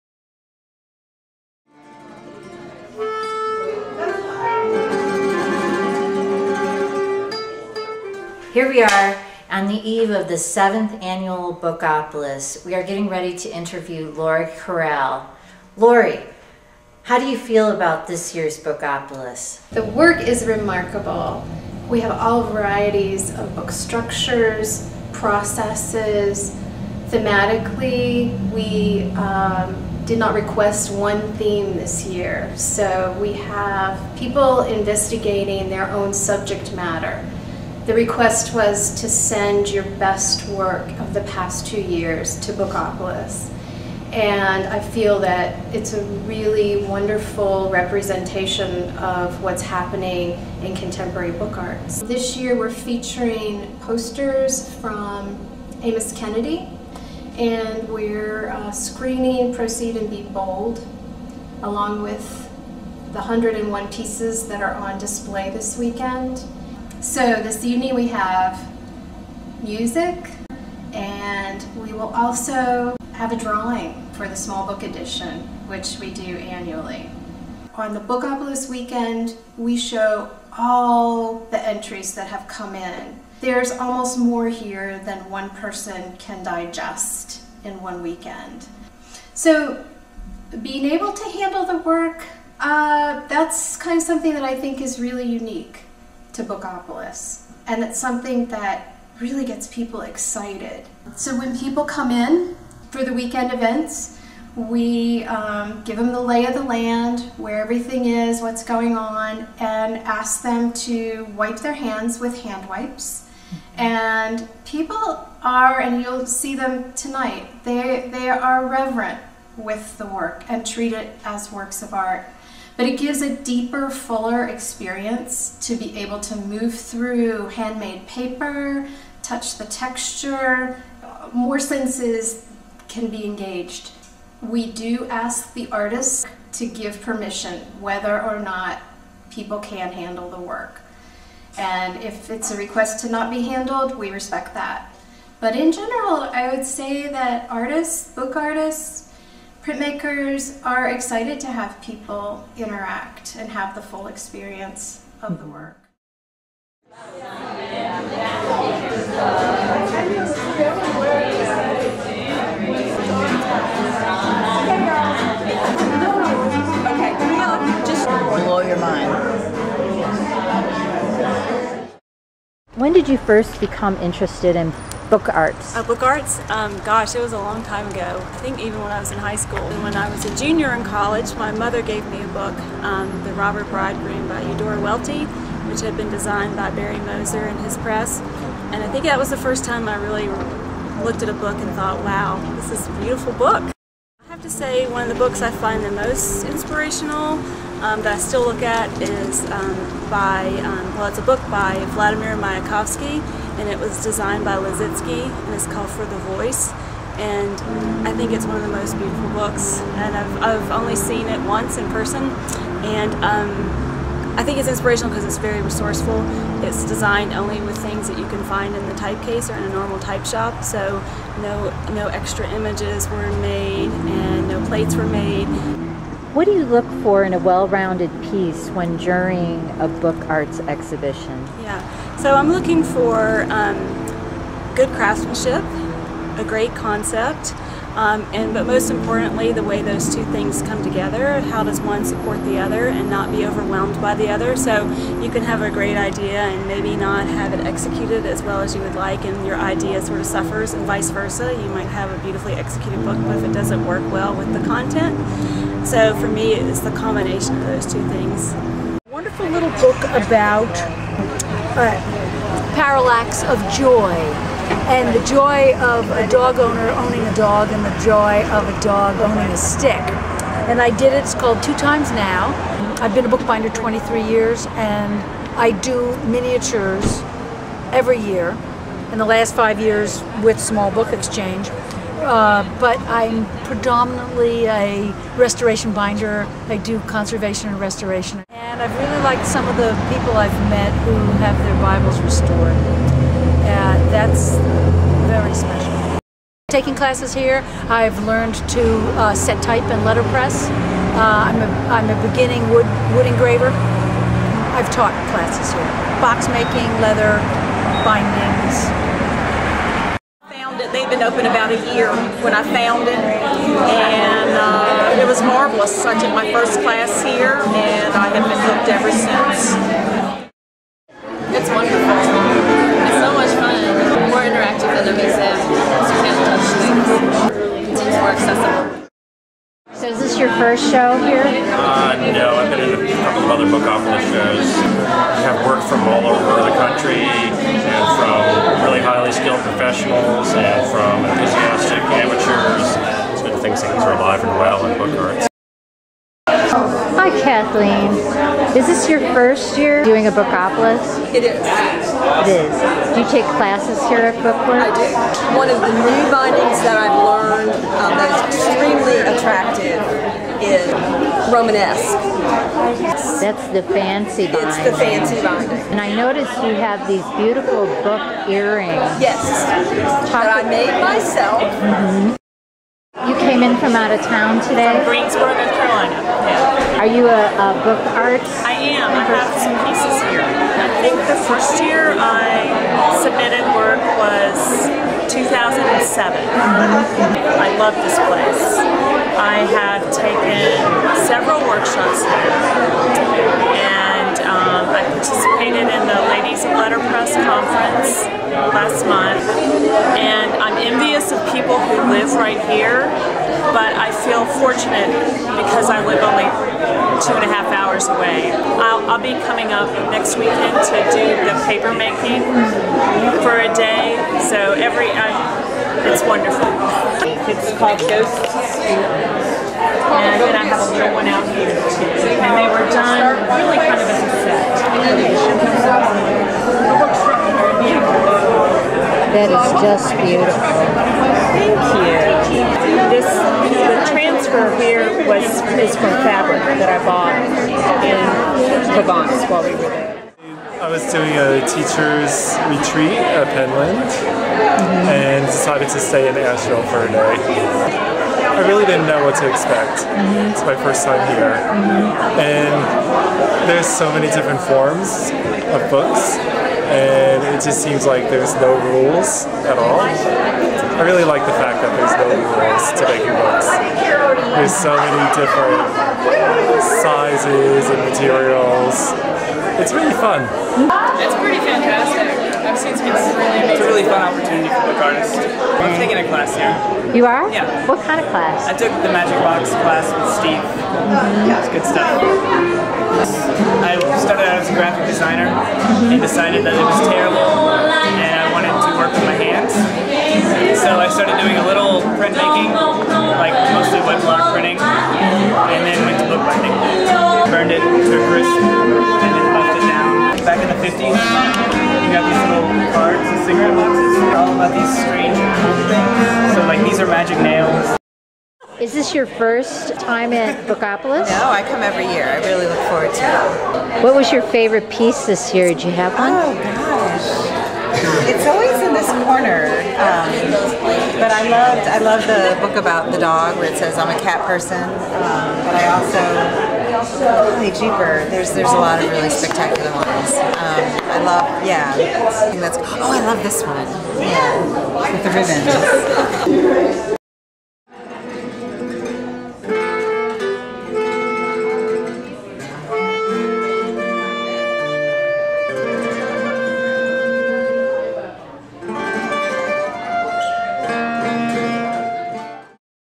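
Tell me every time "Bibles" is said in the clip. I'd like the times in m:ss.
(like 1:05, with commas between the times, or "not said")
4:51.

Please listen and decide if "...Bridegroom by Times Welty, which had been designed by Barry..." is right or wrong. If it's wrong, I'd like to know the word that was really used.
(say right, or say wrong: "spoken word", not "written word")
wrong: "Eudora", not "Times".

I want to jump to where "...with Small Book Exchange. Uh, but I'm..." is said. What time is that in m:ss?
4:40.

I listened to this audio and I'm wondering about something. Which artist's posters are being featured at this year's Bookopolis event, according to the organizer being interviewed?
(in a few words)
Amos Kennedy.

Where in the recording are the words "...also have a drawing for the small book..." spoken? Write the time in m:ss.
1:12.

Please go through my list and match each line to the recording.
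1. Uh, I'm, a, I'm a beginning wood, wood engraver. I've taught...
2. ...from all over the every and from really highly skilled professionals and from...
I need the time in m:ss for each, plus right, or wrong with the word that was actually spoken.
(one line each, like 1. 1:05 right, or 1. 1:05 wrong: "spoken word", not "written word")
1. 5:00 right
2. 5:35 wrong: "country", not "every".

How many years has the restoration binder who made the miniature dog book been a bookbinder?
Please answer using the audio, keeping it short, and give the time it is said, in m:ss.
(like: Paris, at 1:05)
23, at 4:33.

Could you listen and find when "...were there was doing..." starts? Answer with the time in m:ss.
7:19.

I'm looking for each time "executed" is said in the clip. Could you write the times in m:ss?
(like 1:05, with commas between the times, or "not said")
4:07, 4:12.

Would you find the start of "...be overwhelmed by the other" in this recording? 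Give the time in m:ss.
4:03.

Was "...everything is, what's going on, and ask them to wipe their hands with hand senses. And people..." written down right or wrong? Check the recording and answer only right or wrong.
wrong.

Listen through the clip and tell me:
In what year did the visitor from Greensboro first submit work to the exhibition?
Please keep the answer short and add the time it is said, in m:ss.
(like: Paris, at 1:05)
2007, at 6:25.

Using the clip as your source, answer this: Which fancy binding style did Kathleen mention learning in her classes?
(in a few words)
Romanesque.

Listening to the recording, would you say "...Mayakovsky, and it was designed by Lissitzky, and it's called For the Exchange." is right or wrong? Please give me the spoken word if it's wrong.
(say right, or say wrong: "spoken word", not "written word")
wrong: "Voice", not "Exchange".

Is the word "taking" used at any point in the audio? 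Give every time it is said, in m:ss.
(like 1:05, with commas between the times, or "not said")
4:56, 7:55.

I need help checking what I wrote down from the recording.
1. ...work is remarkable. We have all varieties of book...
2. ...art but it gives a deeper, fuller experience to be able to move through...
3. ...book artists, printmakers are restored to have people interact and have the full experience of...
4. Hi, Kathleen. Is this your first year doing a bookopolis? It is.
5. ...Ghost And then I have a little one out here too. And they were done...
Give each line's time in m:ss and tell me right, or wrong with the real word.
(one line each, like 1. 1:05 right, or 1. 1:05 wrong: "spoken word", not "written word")
1. 0:19 right
2. 2:01 right
3. 2:28 wrong: "excited", not "restored"
4. 5:46 right
5. 6:58 right.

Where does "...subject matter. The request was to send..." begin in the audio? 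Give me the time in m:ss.
0:36.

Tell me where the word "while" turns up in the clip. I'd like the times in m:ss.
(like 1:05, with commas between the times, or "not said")
7:19.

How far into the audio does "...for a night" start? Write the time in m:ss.
7:26.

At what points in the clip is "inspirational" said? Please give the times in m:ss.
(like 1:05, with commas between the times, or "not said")
3:16, 3:34.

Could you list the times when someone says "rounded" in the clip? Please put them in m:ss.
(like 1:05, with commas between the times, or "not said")
3:47.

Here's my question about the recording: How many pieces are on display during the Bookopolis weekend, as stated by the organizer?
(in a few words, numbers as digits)
101.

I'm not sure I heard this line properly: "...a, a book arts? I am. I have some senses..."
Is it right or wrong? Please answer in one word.
wrong.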